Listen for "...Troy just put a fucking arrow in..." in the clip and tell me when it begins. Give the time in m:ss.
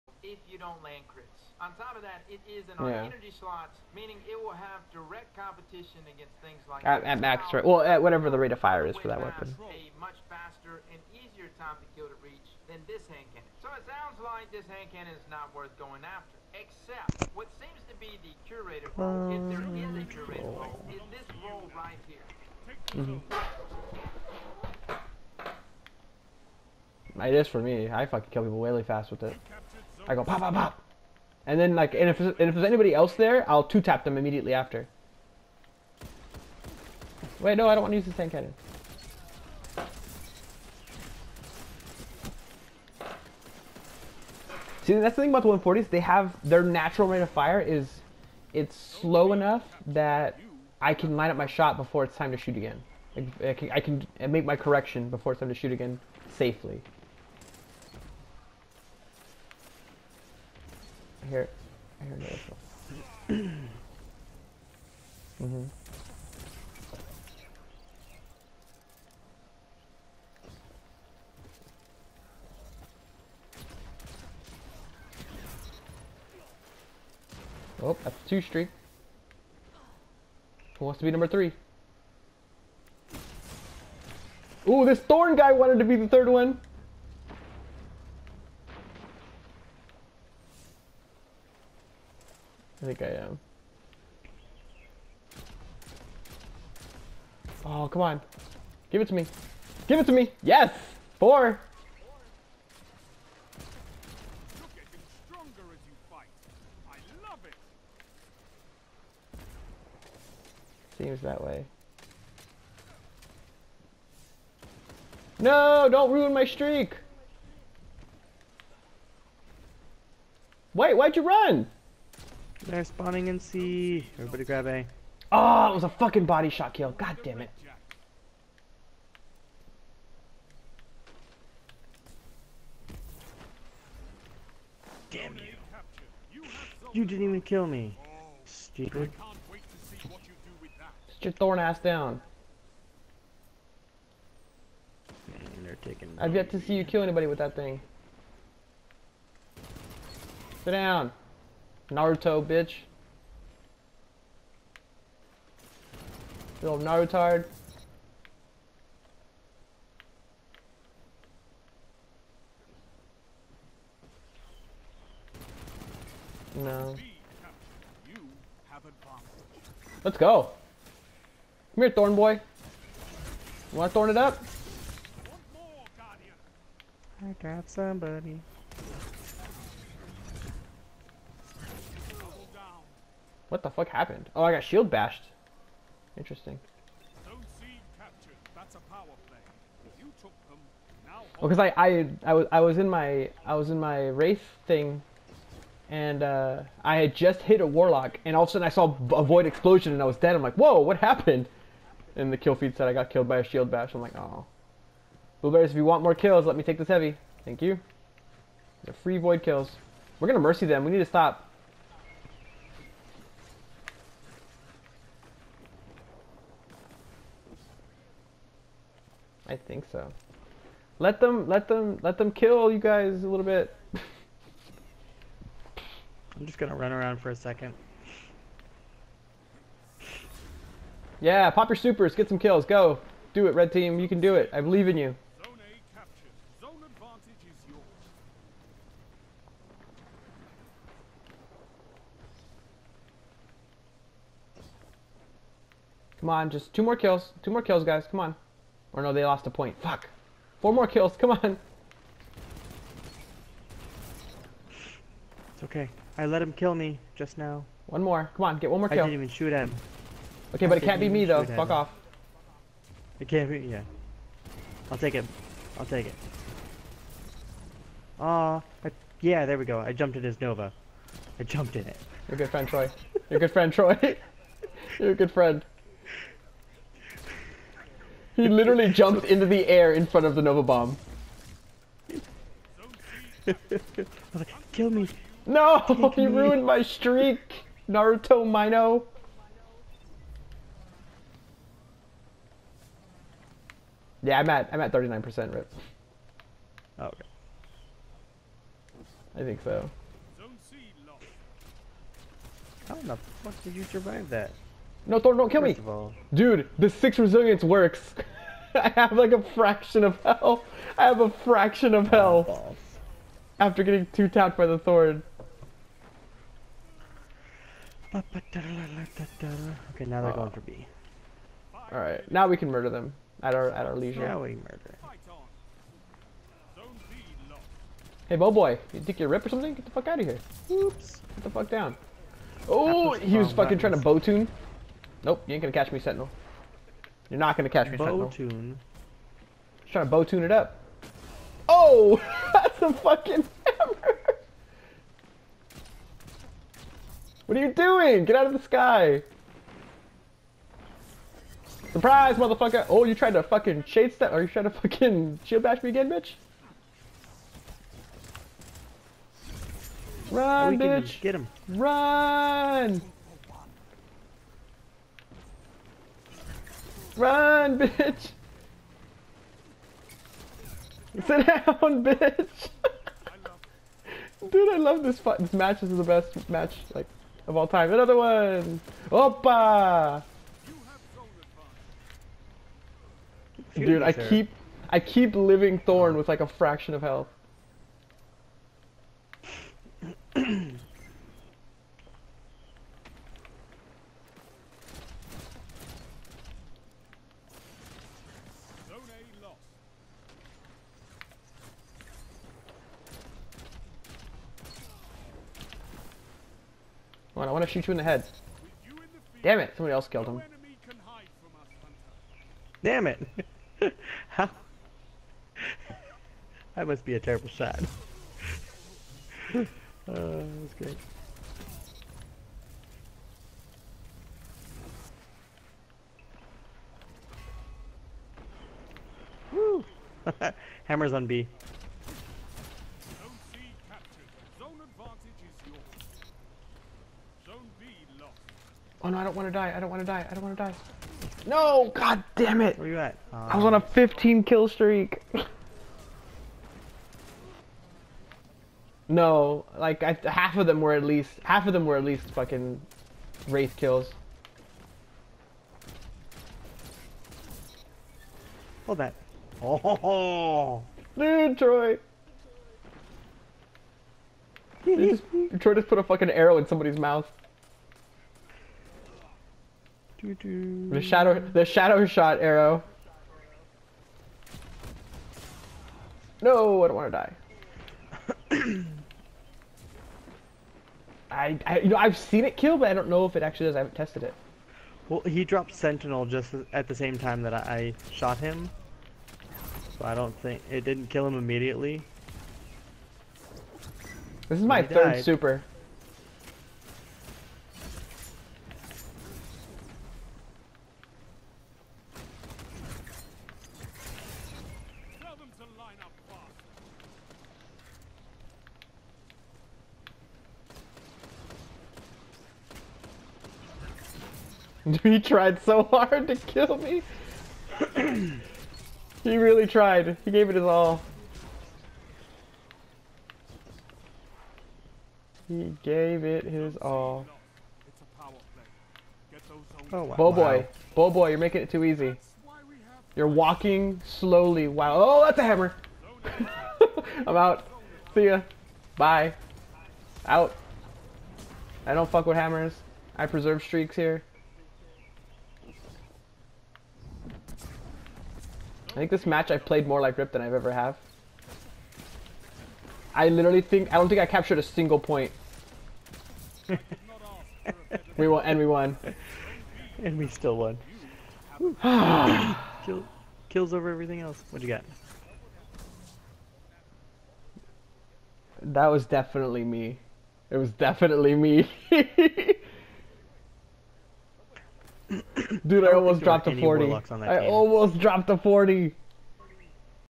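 7:45.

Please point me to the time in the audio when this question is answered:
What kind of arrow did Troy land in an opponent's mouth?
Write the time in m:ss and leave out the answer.
7:51.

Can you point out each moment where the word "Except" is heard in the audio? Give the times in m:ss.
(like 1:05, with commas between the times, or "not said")
0:16.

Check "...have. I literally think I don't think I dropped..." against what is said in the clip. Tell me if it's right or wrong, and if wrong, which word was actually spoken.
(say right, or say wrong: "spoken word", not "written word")
wrong: "captured", not "dropped".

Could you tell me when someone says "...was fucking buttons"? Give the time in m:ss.
5:33.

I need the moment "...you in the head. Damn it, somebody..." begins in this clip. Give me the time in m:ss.
6:47.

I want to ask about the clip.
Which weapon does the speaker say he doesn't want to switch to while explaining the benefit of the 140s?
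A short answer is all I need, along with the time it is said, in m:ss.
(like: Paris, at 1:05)
tank cannon, at 0:38.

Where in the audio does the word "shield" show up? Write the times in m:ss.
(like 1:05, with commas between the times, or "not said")
3:04, 3:23, 5:55.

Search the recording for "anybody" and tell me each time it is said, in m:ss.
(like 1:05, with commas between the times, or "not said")
0:32, 2:27.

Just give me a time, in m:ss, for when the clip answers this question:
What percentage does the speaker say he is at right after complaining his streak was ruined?
4:54.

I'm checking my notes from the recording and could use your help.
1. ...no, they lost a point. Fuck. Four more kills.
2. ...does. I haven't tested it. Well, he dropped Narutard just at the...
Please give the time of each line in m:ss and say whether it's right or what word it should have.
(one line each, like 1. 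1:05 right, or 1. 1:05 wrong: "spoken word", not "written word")
1. 4:09 right
2. 8:03 wrong: "Sentinel", not "Narutard".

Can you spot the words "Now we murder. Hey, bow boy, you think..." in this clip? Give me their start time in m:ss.
5:24.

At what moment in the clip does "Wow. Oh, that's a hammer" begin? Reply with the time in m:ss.
8:54.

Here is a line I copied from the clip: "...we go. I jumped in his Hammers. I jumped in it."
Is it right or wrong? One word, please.
wrong.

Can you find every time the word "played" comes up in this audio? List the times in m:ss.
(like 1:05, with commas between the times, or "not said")
9:09.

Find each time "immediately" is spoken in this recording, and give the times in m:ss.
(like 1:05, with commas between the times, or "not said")
0:34, 8:11.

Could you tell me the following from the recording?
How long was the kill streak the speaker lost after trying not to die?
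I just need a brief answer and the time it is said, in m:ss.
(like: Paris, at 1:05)
15, at 7:23.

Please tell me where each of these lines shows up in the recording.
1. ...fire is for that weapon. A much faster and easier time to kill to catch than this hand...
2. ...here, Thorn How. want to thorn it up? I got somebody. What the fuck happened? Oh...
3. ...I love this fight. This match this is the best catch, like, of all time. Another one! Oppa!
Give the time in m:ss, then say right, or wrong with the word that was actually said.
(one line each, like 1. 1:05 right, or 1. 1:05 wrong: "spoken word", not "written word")
1. 0:08 wrong: "reach", not "catch"
2. 2:51 wrong: "Boy", not "How"
3. 6:14 wrong: "match", not "catch".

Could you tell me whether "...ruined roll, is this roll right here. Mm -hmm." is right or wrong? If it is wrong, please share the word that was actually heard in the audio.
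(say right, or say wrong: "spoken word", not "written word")
wrong: "curated", not "ruined".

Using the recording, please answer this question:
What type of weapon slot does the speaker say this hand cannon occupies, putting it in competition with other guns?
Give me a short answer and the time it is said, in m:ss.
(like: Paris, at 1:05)
energy slot, at 0:03.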